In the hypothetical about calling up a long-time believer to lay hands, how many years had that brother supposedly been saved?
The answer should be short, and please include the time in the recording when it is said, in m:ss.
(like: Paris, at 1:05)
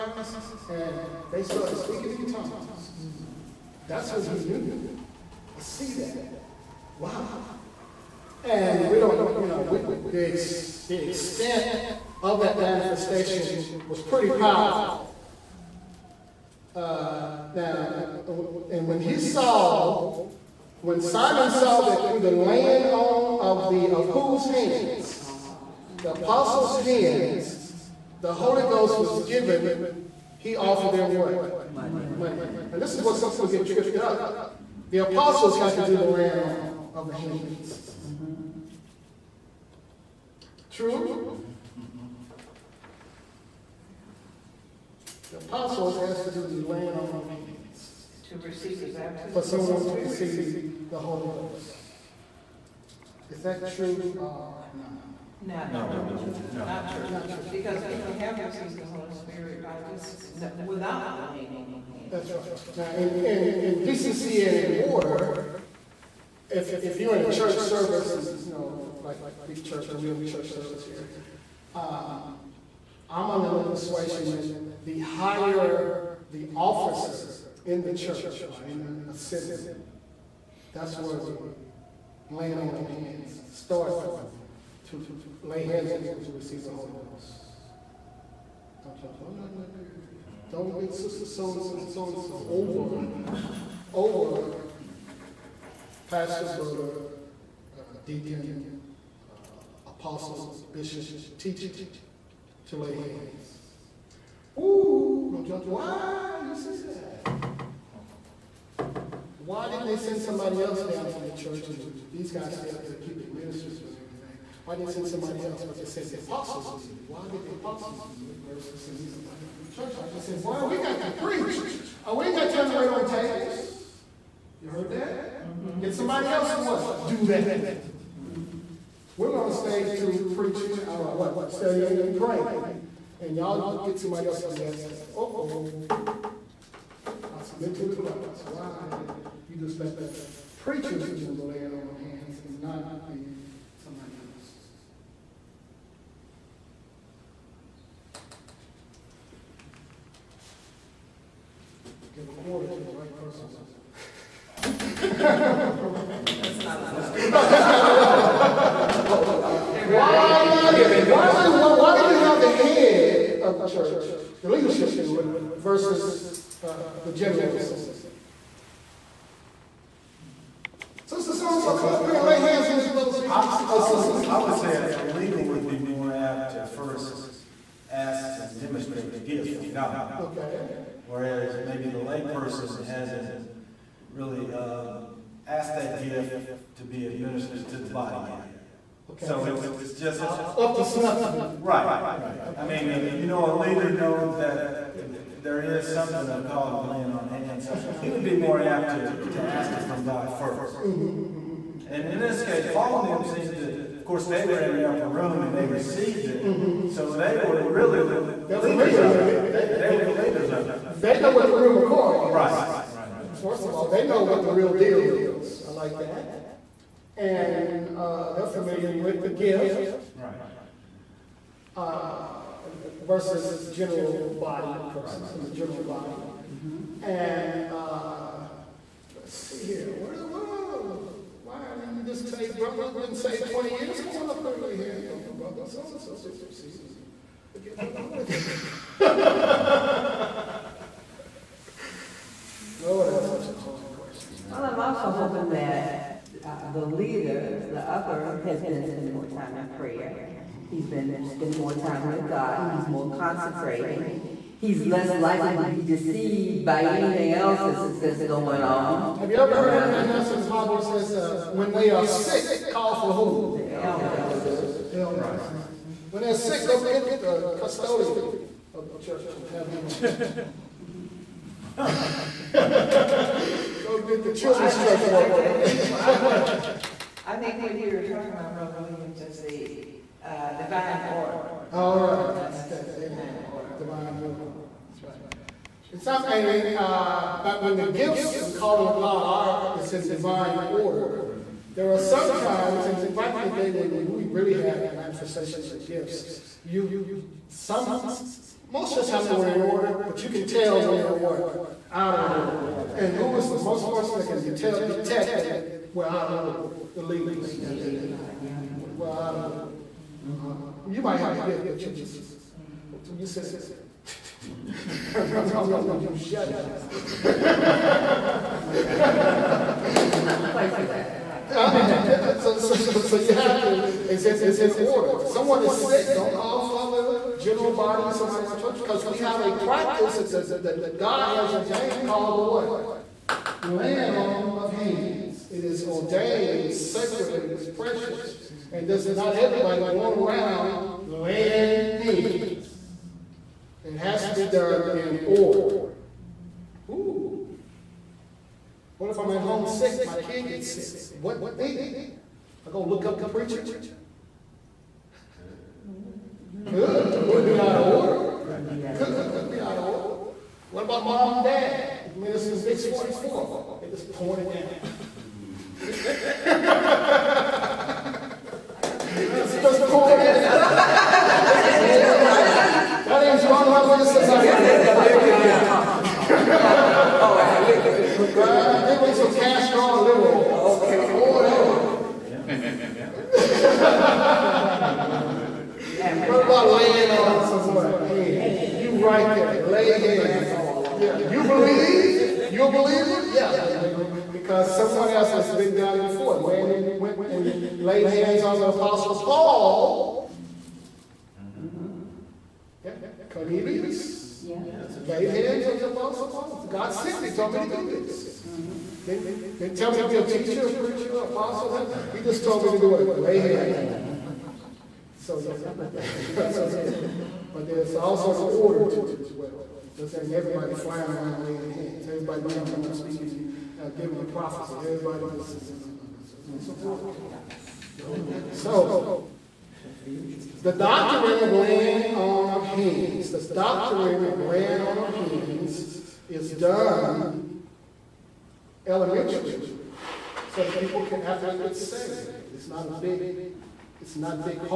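20 years, at 3:52.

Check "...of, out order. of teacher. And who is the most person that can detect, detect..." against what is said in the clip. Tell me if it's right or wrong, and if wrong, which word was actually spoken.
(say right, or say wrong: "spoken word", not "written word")
wrong: "order", not "teacher".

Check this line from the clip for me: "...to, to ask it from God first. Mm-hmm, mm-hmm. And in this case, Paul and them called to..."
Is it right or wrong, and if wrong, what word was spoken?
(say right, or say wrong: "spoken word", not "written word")
wrong: "seemed", not "called".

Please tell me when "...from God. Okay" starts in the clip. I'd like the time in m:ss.
2:59.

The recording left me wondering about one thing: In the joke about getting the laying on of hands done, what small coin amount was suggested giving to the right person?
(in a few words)
A quarter.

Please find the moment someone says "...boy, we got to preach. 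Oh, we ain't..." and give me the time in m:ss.
2:00.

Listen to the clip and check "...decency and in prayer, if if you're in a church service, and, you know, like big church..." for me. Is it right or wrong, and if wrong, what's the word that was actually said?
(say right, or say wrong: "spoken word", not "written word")
wrong: "order", not "prayer".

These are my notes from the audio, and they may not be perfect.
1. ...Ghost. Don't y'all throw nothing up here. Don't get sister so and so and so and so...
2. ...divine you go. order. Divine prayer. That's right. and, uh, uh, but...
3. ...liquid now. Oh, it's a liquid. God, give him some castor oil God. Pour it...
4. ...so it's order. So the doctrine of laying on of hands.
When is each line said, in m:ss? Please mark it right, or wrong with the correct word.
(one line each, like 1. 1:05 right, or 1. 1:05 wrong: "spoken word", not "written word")
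1. 1:27 right
2. 4:42 wrong: "order", not "prayer"
3. 6:15 wrong: "Okay", not "God"
4. 7:06 right.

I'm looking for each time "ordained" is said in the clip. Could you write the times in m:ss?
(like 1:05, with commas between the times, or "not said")
5:31, 5:35.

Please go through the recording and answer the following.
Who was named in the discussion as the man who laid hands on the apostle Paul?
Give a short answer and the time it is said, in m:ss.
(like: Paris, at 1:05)
Cornelius, at 6:43.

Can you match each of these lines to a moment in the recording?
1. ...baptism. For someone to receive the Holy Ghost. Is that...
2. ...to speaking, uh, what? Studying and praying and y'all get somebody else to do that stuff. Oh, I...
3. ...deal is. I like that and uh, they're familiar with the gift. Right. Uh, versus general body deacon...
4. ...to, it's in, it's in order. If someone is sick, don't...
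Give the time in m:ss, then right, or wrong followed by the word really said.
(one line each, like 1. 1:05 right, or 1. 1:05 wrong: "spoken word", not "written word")
1. 0:48 right
2. 2:09 wrong: "preaching", not "speaking"
3. 3:34 wrong: "person", not "deacon"
4. 5:23 right.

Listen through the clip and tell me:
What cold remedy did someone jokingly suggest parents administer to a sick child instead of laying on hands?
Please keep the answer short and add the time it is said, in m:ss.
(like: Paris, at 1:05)
Vicks 44, at 6:02.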